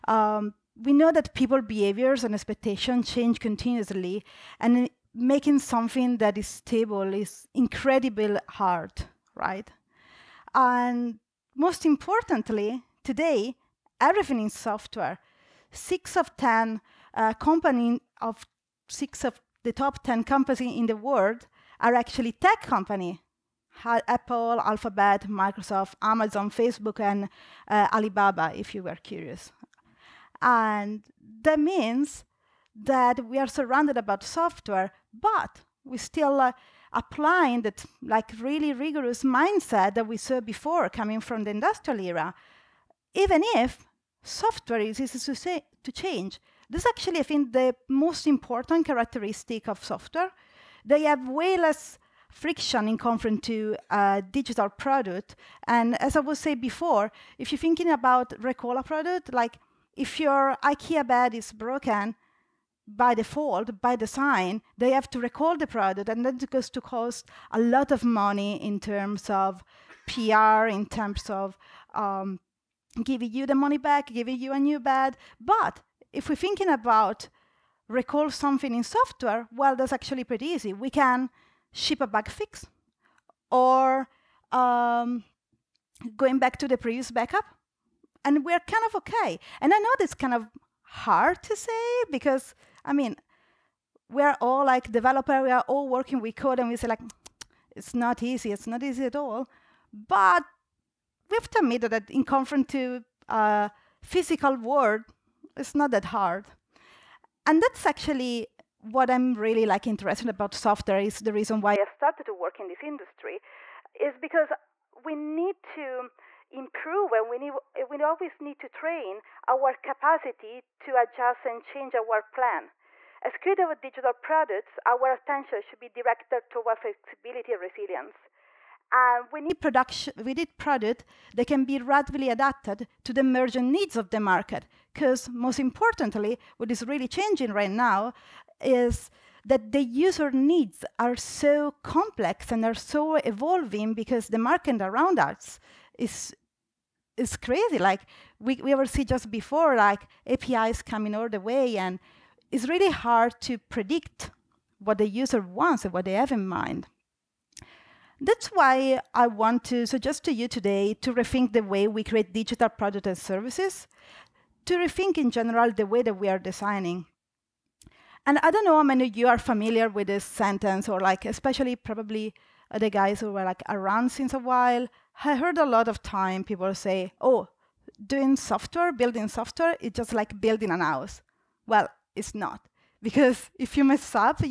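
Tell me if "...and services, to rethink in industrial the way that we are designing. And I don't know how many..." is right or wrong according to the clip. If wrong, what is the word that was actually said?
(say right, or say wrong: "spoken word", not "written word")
wrong: "general", not "industrial".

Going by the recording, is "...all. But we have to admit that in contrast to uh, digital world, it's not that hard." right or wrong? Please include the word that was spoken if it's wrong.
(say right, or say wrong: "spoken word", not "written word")
wrong: "physical", not "digital".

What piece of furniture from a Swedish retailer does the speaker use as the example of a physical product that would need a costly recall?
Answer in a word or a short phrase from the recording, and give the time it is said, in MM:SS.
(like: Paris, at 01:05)
IKEA bed, at 01:00.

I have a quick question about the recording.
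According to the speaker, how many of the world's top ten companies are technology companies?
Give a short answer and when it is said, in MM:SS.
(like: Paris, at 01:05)
6, at 00:18.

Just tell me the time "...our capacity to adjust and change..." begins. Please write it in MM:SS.
01:59.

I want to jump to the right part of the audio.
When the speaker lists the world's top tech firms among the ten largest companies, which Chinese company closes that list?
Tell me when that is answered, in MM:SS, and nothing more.
00:27.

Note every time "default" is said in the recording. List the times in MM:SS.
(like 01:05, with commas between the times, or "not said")
01:03.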